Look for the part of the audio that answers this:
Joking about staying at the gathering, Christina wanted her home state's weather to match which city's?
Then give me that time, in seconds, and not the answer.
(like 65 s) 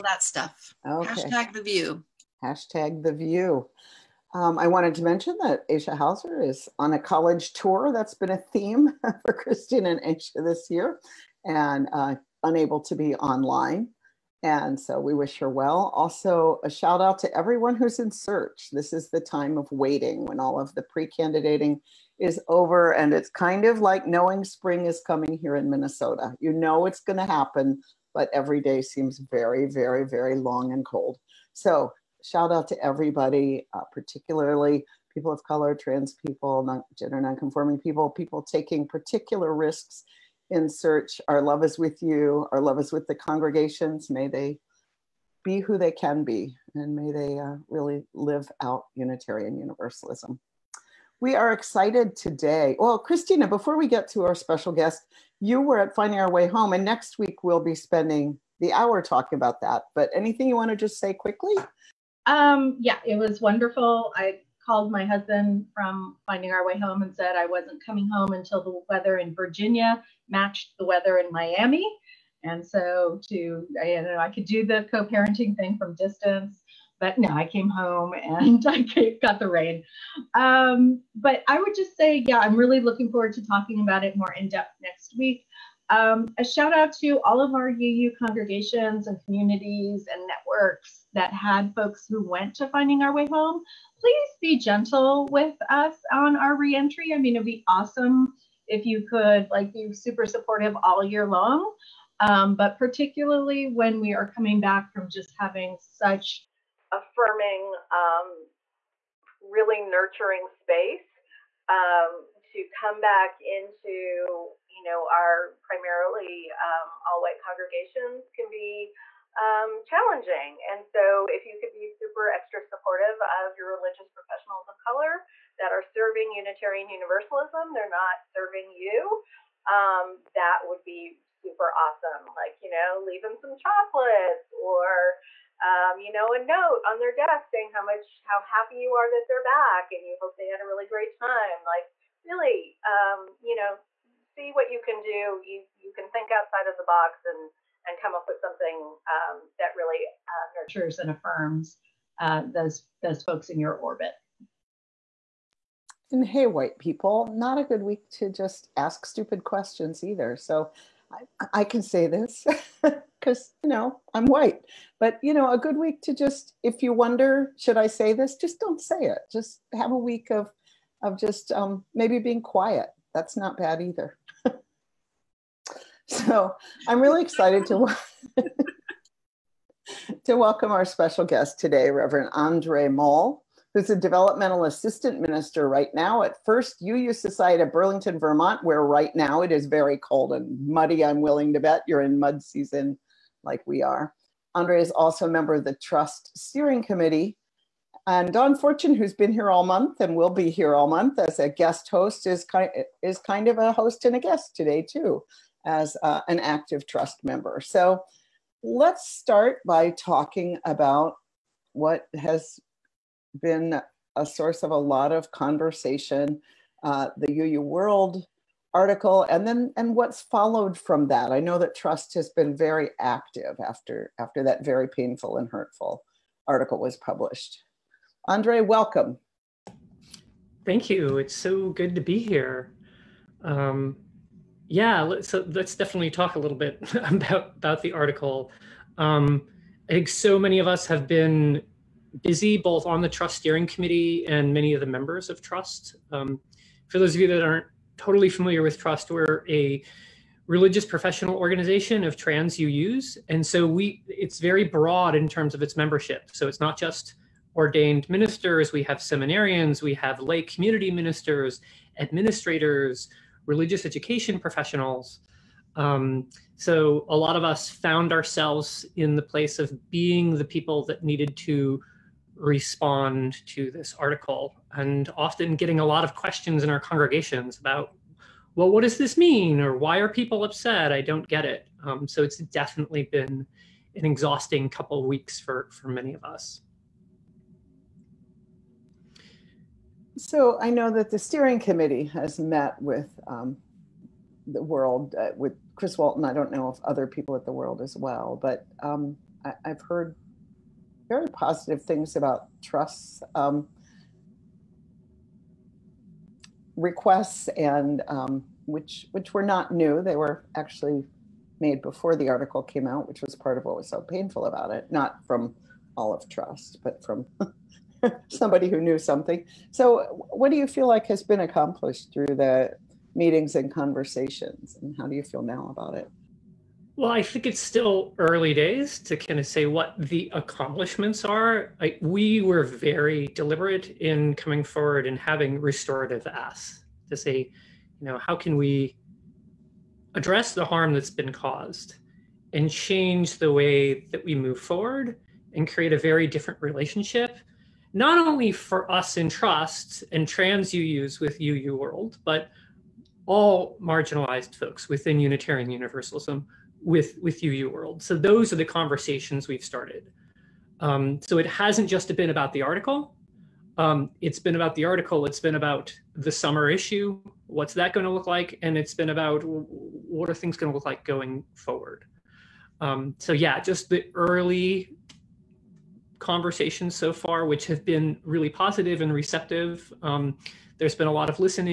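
71 s.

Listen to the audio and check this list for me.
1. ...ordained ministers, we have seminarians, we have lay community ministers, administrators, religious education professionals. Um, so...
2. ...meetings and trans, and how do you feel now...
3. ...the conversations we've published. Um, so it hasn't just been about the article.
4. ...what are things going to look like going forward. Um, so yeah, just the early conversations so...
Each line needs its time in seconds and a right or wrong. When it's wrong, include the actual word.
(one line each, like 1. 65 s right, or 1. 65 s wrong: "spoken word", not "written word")
1. 257 s right
2. 323 s wrong: "conversations", not "trans"
3. 358 s wrong: "started", not "published"
4. 369 s right.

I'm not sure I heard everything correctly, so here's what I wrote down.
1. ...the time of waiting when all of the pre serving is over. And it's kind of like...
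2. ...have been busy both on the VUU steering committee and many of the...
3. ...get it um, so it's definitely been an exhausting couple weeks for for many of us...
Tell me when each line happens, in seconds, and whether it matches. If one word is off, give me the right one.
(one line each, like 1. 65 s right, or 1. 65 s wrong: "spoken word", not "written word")
1. 19 s wrong: "candidating", not "serving"
2. 240 s wrong: "TRUUsT", not "VUU"
3. 281 s right.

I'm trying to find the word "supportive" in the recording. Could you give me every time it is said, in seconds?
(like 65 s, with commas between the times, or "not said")
100 s, 122 s.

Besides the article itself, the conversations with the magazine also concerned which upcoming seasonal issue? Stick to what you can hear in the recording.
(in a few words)
summer issue.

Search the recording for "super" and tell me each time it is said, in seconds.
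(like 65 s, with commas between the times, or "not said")
99 s, 121 s, 131 s.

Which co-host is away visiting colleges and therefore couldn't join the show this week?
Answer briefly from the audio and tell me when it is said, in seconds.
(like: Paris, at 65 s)
Aisha Hauser, at 5 s.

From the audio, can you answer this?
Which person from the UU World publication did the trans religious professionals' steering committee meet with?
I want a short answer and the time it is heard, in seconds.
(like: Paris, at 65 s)
Chris Walton, at 295 s.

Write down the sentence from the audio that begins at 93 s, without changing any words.
Please be gentle with us on our reentry.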